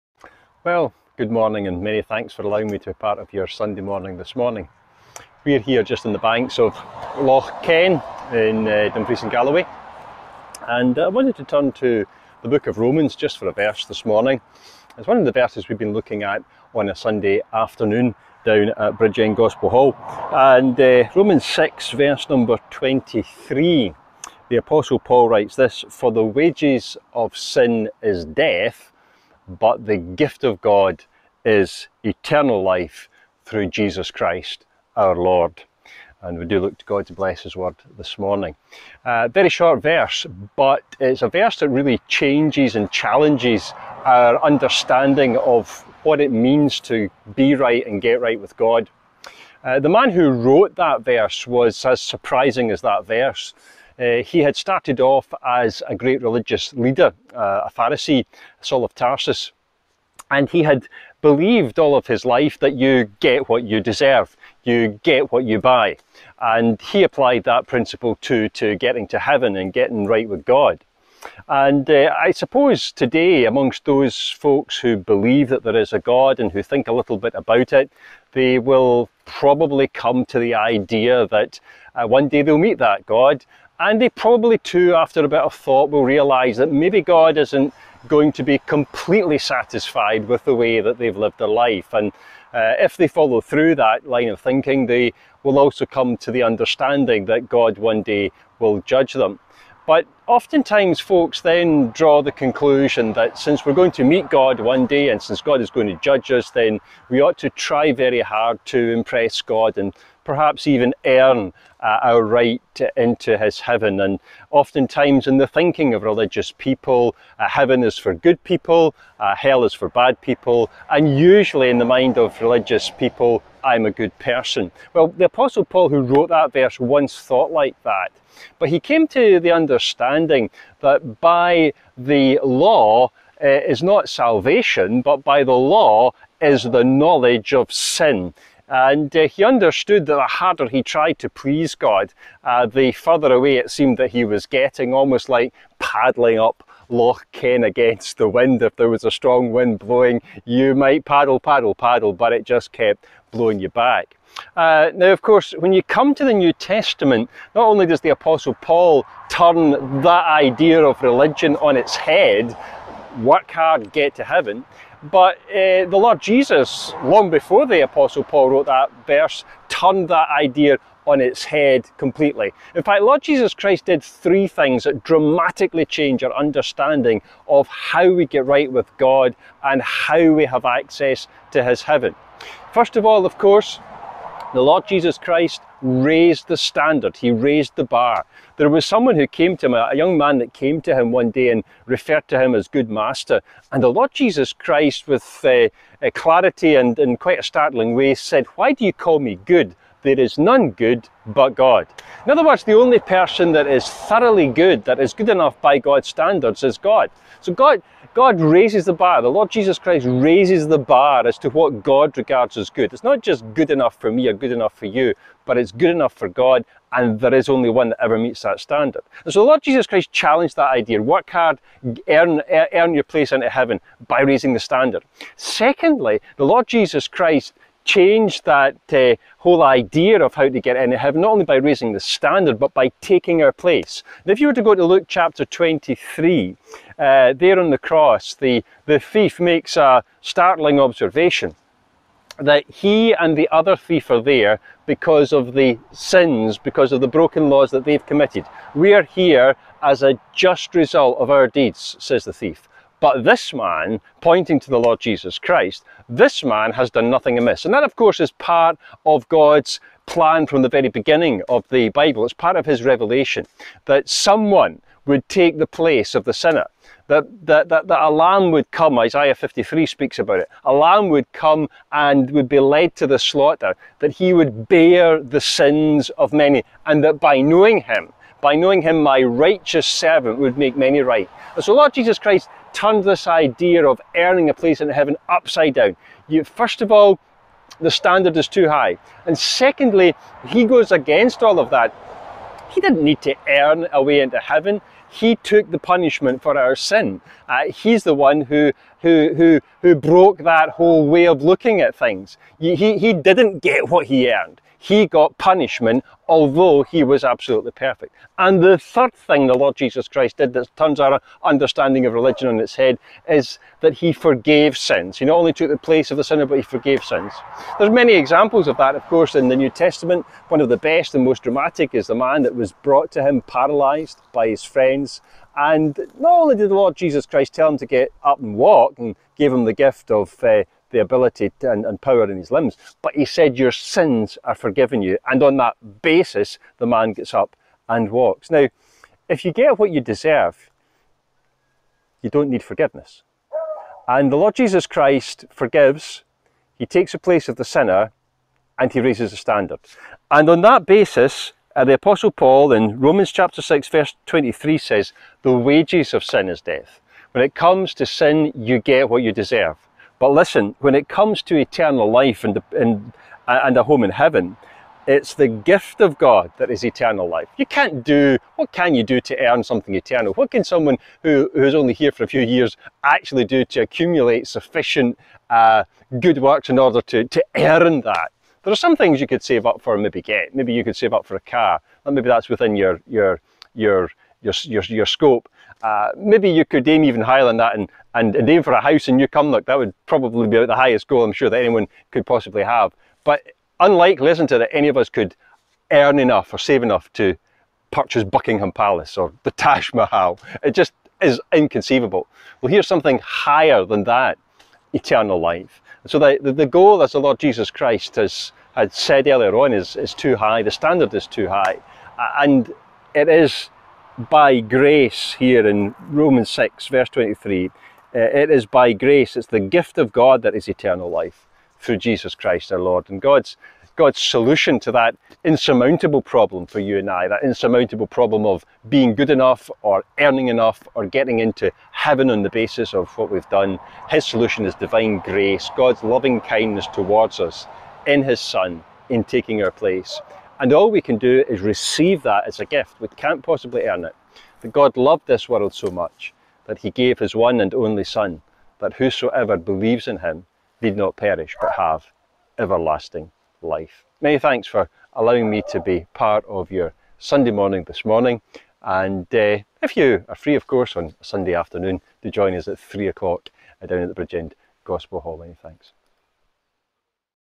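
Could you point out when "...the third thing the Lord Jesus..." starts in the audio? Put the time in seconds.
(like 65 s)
308 s.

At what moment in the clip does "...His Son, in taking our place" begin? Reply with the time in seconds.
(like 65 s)
438 s.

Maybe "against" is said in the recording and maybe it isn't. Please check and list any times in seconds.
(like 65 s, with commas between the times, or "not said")
147 s, 290 s.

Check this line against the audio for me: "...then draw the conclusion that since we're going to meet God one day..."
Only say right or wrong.
right.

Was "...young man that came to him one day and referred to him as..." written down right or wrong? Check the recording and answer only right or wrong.
right.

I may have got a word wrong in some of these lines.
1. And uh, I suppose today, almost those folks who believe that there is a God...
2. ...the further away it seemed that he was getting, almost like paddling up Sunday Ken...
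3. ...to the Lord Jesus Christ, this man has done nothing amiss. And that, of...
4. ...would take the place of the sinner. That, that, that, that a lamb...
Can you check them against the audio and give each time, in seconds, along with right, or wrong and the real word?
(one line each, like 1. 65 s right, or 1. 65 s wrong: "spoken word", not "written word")
1. 71 s wrong: "amongst", not "almost"
2. 142 s wrong: "Loch", not "Sunday"
3. 254 s right
4. 265 s right.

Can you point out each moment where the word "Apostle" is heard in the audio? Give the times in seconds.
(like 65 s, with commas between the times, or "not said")
24 s, 125 s, 158 s, 167 s, 351 s.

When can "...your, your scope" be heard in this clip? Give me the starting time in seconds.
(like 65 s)
384 s.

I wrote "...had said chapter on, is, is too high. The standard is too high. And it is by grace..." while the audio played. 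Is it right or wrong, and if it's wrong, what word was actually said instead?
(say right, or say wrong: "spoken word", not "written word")
wrong: "earlier", not "chapter".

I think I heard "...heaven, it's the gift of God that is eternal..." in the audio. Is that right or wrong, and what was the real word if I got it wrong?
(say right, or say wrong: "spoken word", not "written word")
right.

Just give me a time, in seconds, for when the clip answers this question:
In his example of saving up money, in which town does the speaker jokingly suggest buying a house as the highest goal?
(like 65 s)
389 s.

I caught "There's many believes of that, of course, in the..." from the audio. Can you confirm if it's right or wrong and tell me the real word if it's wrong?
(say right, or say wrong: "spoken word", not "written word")
wrong: "examples", not "believes".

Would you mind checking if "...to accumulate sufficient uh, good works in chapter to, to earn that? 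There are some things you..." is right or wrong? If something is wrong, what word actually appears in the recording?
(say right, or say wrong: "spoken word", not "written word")
wrong: "order", not "chapter".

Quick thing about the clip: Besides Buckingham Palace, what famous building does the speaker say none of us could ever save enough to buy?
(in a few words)
Taj Mahal.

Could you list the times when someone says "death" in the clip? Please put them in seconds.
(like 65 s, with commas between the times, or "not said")
28 s, 356 s.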